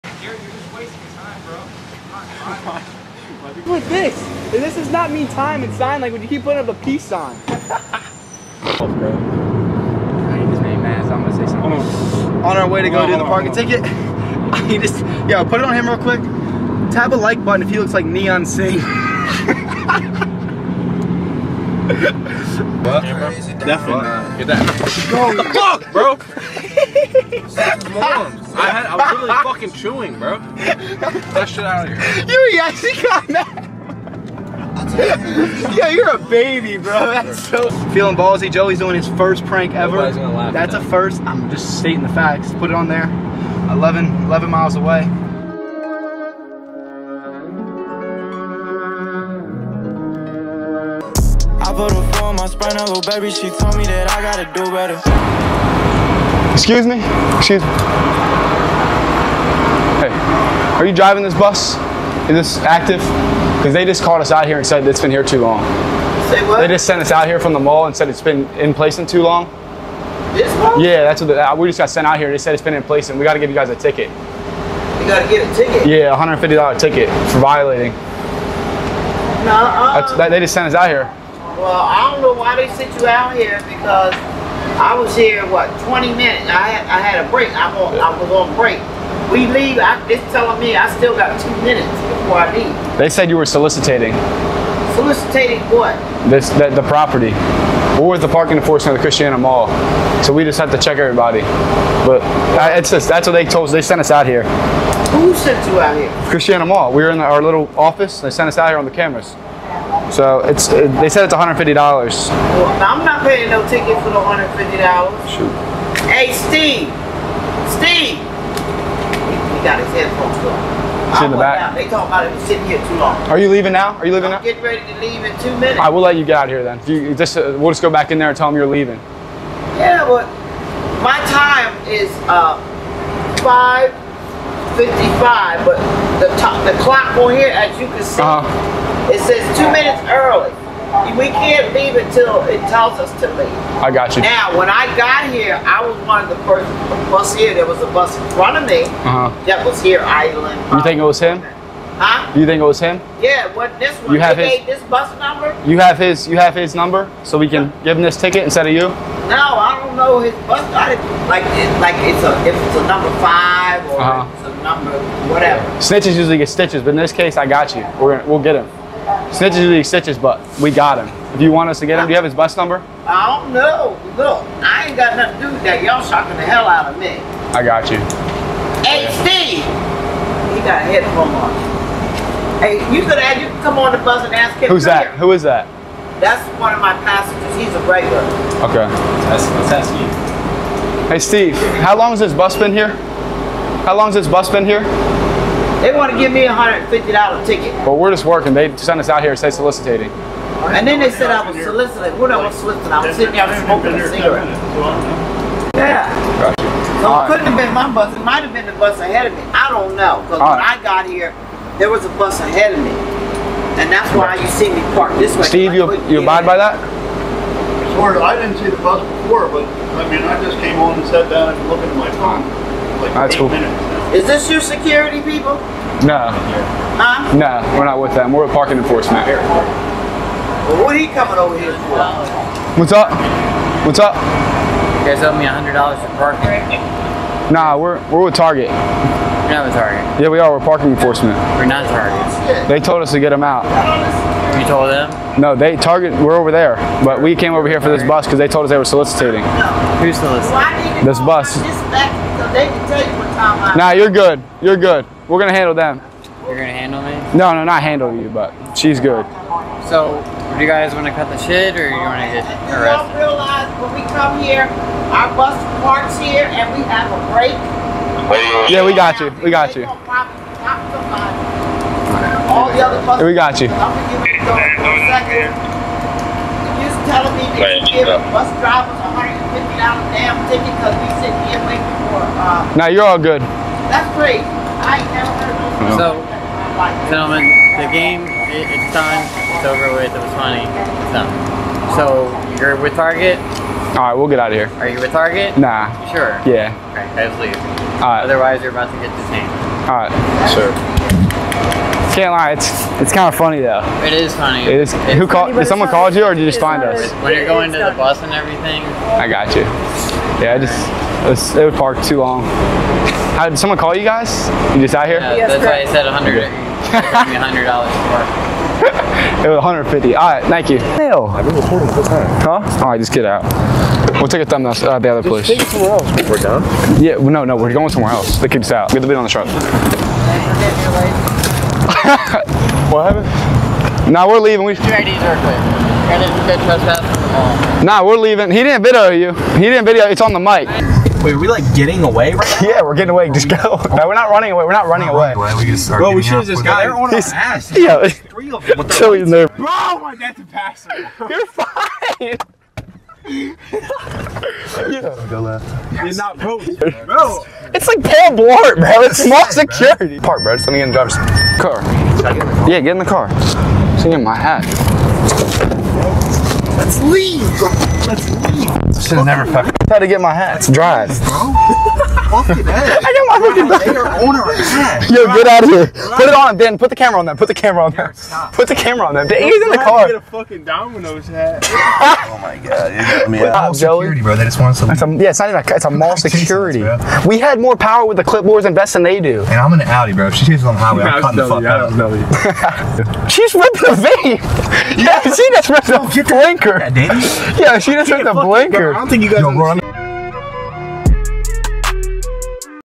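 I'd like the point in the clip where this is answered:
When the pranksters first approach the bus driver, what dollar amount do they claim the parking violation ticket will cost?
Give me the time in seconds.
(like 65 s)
76 s.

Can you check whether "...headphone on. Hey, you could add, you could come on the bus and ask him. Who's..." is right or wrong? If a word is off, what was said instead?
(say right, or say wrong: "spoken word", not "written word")
right.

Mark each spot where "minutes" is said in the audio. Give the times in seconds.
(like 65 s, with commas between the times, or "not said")
86 s, 91 s, 125 s, 139 s, 223 s.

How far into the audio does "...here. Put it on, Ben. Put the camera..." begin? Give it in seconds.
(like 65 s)
375 s.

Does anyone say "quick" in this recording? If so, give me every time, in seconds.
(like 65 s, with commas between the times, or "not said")
15 s, 335 s.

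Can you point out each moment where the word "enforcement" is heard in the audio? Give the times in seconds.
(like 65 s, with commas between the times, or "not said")
98 s, 228 s, 240 s.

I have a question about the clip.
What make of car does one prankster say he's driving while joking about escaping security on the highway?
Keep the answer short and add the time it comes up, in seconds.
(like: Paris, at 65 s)
Audi, at 389 s.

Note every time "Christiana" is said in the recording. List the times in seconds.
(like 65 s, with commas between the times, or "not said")
99 s, 106 s.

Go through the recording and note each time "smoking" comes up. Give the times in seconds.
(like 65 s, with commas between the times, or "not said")
203 s.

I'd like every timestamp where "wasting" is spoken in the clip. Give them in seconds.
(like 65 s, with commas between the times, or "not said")
0 s.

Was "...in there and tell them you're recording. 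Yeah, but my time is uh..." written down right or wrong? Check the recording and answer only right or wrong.
wrong.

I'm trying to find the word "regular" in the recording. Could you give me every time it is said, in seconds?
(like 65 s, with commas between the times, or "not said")
187 s.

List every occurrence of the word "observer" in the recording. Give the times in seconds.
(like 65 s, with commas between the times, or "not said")
not said.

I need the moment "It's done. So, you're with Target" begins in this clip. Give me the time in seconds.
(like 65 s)
290 s.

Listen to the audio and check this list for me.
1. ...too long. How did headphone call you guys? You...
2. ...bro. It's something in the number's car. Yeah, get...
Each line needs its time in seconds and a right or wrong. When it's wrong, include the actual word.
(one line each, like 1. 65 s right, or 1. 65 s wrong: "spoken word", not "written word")
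1. 312 s wrong: "someone", not "headphone"
2. 360 s wrong: "driver", not "number".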